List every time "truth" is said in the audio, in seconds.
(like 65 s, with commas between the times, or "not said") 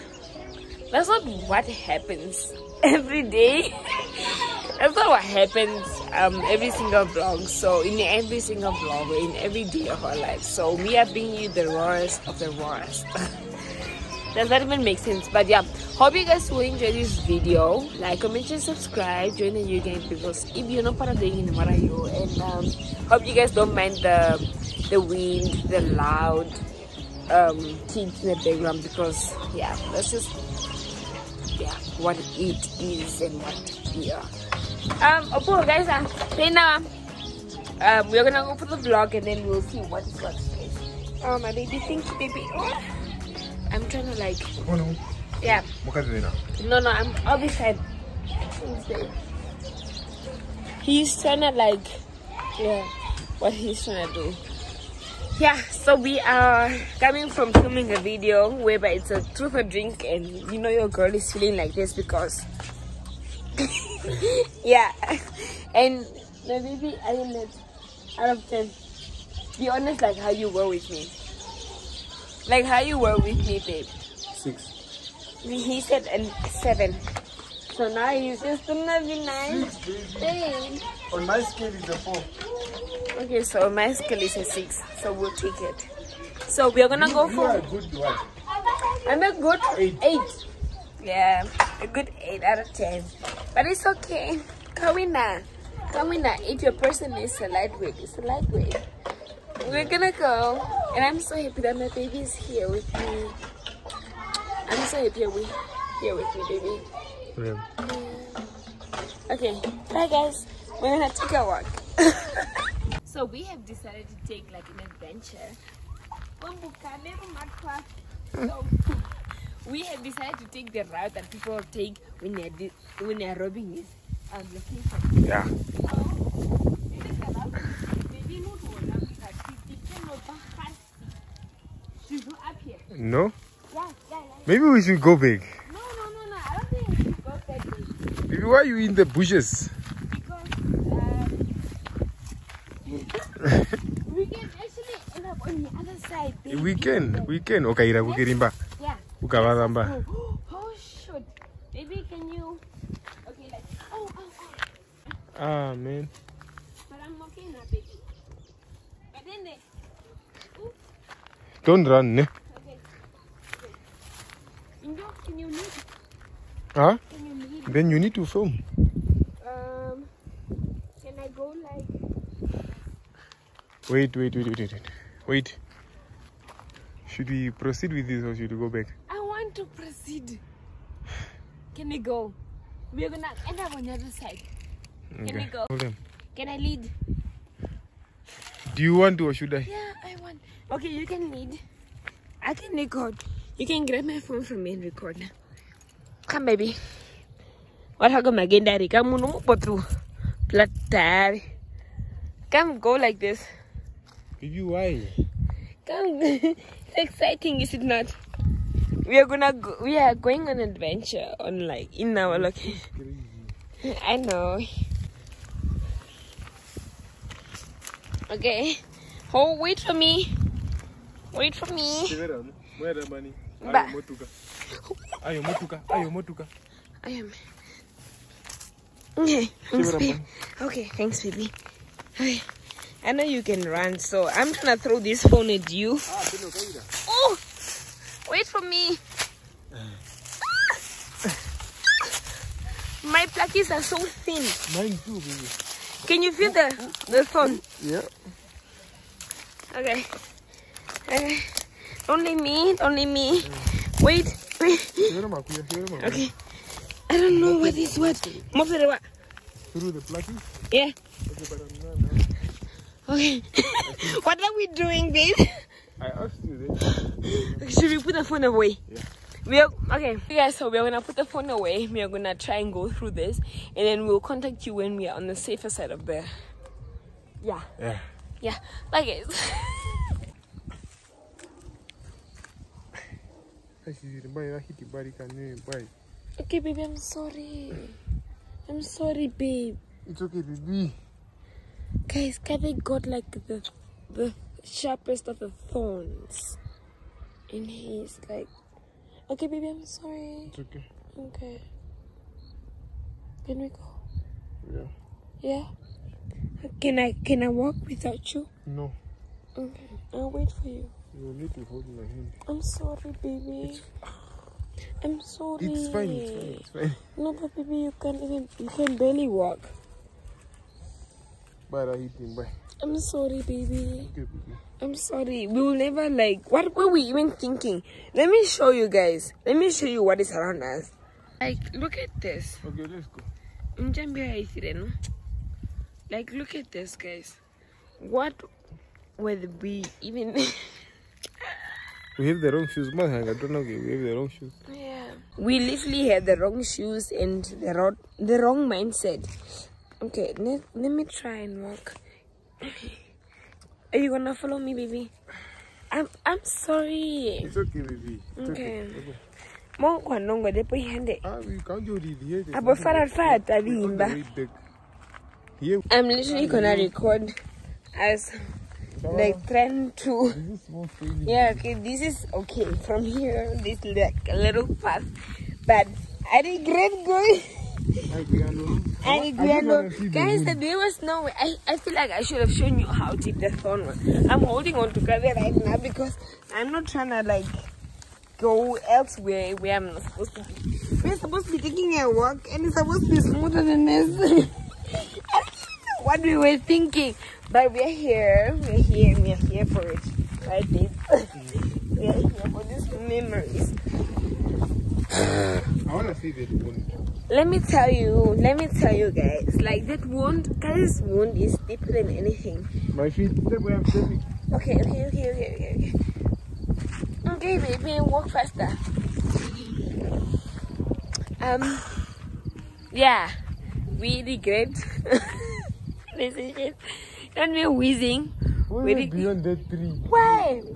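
59 s.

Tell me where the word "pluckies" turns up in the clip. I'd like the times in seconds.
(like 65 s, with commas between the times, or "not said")
243 s, 260 s.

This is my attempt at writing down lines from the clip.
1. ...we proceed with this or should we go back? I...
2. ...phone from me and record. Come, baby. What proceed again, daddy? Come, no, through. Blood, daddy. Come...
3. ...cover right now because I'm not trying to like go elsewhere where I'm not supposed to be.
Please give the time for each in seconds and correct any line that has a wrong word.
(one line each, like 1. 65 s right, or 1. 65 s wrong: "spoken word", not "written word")
1. 177 s right
2. 194 s wrong: "happened", not "proceed"
3. 384 s right.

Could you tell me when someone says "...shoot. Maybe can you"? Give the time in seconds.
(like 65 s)
150 s.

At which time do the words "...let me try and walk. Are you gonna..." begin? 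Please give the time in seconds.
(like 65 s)
350 s.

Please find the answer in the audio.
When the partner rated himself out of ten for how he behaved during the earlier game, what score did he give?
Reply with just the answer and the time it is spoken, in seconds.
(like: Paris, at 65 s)
8, at 89 s.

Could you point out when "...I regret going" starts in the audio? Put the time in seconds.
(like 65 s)
376 s.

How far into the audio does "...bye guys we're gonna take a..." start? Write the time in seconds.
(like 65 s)
109 s.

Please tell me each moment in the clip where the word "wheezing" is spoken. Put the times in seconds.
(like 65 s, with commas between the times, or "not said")
427 s.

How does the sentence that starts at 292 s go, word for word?
Guys, Kathy got like the the sharpest of the thorns in his like.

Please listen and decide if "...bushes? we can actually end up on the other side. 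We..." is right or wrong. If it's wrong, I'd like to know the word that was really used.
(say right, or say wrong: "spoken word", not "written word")
right.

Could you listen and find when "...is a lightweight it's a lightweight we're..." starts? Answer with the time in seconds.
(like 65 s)
97 s.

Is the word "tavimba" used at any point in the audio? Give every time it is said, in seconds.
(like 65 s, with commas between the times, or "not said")
363 s.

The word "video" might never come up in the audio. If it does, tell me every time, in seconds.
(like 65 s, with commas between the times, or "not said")
17 s, 58 s.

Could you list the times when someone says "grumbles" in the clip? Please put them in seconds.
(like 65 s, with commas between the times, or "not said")
not said.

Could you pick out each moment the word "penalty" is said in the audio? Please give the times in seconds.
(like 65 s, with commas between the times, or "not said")
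not said.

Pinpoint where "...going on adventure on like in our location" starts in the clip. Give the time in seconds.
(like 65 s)
210 s.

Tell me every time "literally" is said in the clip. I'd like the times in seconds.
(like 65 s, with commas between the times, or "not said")
345 s, 366 s.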